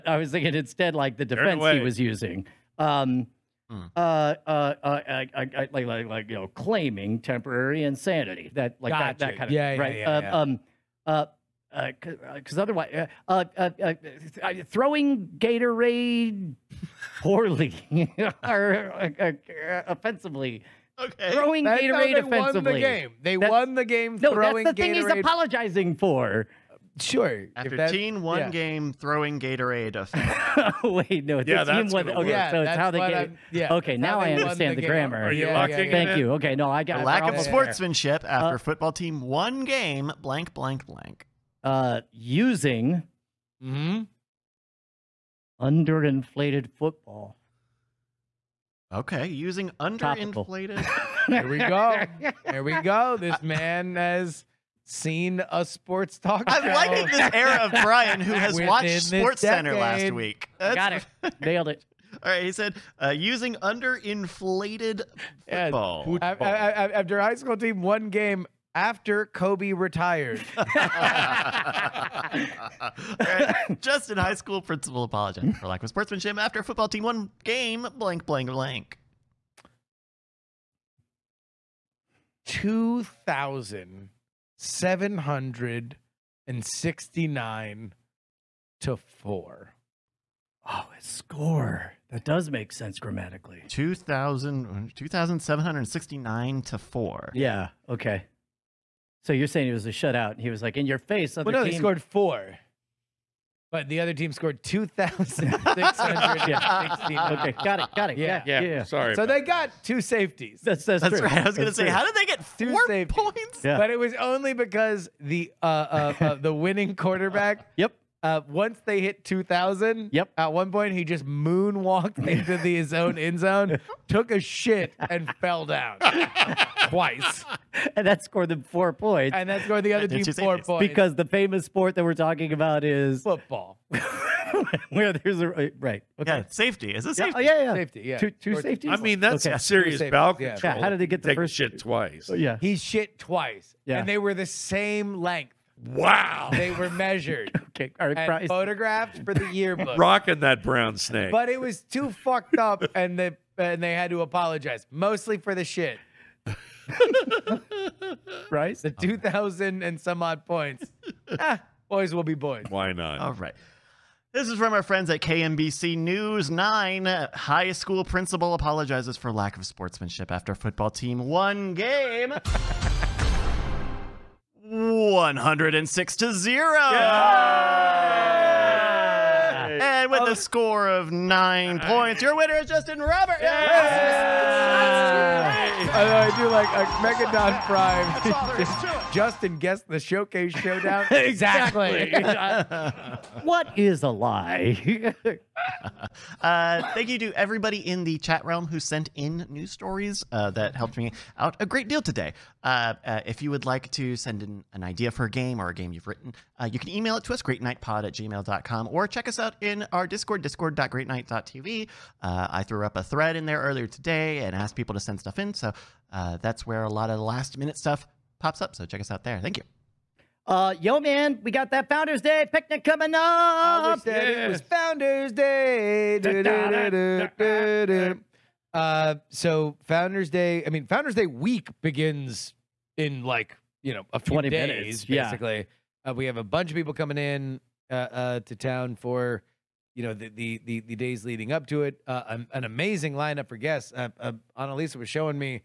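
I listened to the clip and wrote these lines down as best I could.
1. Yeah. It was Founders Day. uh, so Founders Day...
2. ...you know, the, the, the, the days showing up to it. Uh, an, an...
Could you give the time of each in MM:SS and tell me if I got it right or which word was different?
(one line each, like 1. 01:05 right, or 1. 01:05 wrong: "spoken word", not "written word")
1. 03:44 right
2. 03:59 wrong: "leading", not "showing".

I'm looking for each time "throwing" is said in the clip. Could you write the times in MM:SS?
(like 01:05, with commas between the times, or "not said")
00:14, 00:21, 00:28.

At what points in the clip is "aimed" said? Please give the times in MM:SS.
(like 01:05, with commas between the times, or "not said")
not said.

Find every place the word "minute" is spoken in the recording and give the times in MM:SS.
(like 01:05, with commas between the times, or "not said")
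03:37, 03:54.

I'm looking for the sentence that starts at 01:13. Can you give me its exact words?
Justin, high school principal, apologized for lack of sportsmanship after football team one game blank blank blank.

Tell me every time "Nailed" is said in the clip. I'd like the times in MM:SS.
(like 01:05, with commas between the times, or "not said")
01:01.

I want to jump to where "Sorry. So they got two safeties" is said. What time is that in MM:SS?
01:48.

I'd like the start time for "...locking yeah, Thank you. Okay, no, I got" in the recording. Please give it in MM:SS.
00:35.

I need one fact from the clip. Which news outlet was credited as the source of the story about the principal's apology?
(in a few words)
KMBC News 9.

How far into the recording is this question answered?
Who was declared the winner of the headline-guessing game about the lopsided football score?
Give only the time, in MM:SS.
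03:02.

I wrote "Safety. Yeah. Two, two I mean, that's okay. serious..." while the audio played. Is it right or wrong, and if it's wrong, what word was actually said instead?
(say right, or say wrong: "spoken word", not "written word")
right.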